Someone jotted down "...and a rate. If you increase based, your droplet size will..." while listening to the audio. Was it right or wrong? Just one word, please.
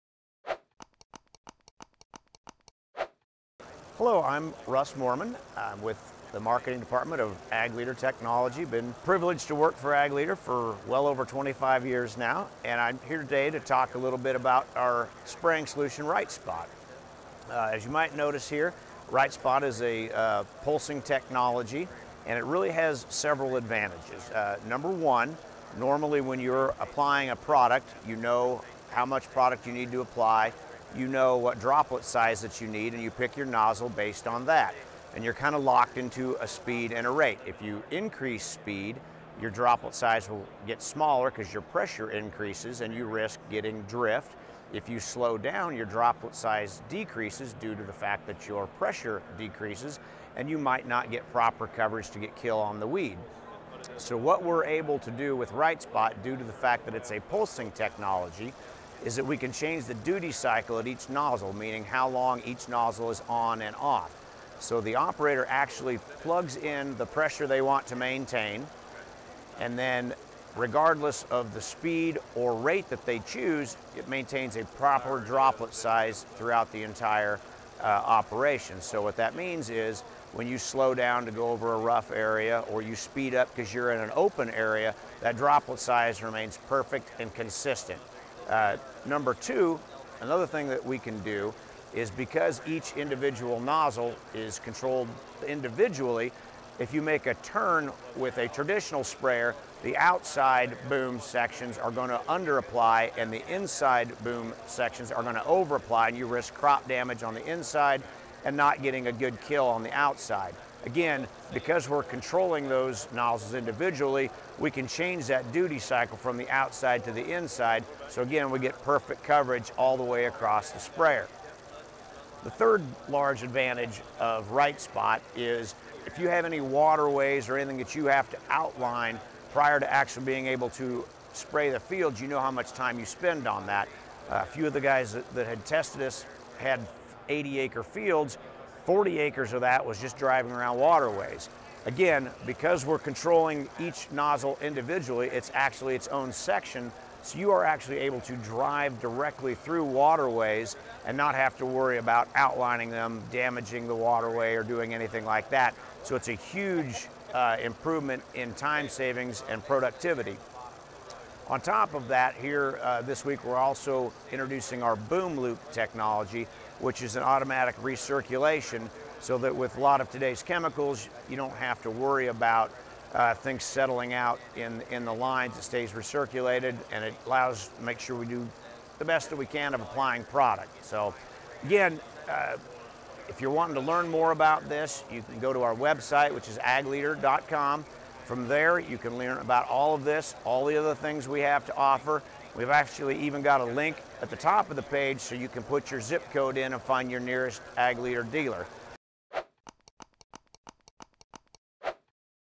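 wrong.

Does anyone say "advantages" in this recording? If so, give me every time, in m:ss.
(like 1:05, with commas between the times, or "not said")
0:23, 2:03.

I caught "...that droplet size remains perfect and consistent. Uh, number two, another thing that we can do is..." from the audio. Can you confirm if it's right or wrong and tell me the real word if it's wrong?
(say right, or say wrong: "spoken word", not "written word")
right.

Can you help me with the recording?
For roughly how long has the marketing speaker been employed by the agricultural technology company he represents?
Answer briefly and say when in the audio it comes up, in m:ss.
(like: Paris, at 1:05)
over 25 years, at 0:10.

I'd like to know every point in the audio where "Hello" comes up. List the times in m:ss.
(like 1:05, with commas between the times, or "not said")
0:04.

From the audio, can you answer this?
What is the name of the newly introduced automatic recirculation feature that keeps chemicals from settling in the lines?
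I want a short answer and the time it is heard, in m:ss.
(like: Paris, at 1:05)
BoomLoop, at 2:44.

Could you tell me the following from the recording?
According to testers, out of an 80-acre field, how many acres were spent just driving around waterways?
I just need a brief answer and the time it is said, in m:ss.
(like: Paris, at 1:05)
40 acres, at 2:18.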